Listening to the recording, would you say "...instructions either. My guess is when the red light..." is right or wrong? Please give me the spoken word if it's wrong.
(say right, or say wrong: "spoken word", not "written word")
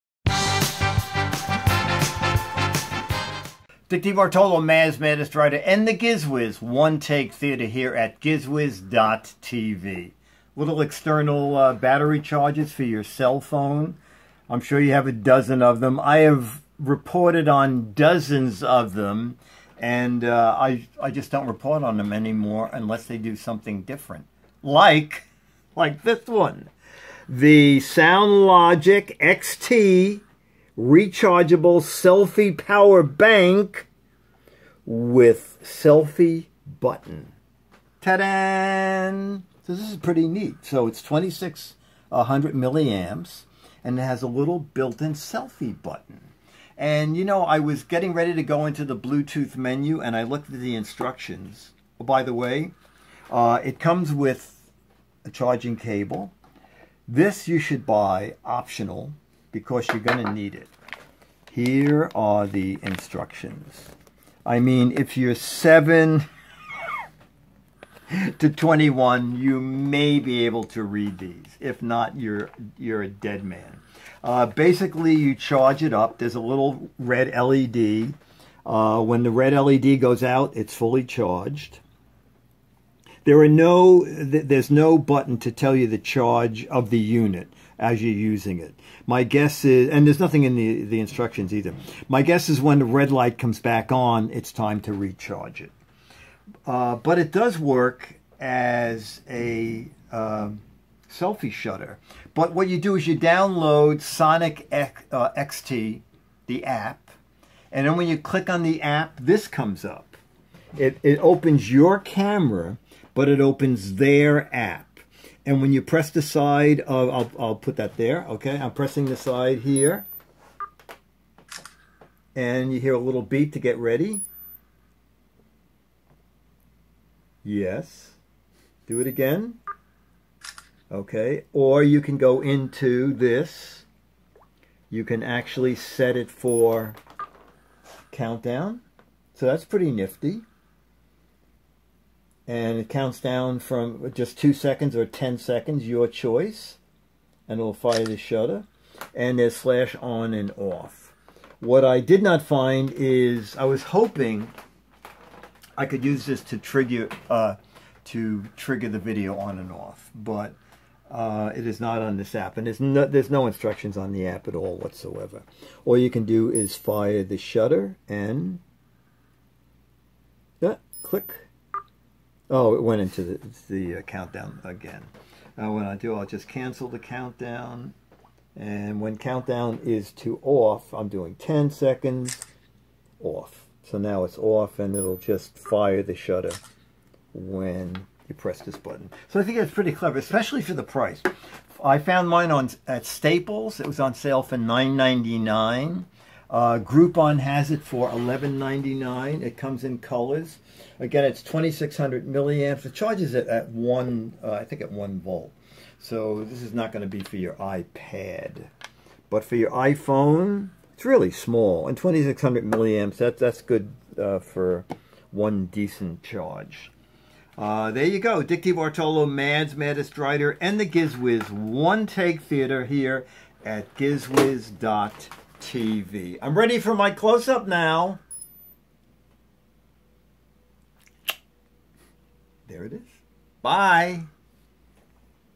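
right.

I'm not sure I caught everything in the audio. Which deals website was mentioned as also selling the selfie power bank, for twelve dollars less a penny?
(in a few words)
Groupon.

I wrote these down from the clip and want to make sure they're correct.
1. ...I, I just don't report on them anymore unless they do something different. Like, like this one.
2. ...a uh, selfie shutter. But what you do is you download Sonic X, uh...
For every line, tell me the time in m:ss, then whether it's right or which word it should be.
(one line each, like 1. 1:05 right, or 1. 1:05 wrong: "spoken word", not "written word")
1. 0:20 right
2. 1:39 right.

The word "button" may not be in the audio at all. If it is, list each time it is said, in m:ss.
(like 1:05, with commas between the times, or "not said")
0:36, 0:45, 1:24, 3:08.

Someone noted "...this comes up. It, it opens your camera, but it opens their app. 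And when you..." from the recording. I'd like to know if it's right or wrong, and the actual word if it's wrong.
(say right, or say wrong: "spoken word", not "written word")
right.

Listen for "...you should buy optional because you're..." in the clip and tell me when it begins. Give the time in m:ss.
0:57.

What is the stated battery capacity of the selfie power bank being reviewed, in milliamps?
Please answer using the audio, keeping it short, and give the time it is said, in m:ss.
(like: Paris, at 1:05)
2600, at 0:41.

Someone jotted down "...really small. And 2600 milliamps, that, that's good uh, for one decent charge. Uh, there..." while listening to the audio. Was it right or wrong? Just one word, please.
right.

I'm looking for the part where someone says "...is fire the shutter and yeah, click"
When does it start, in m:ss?
2:46.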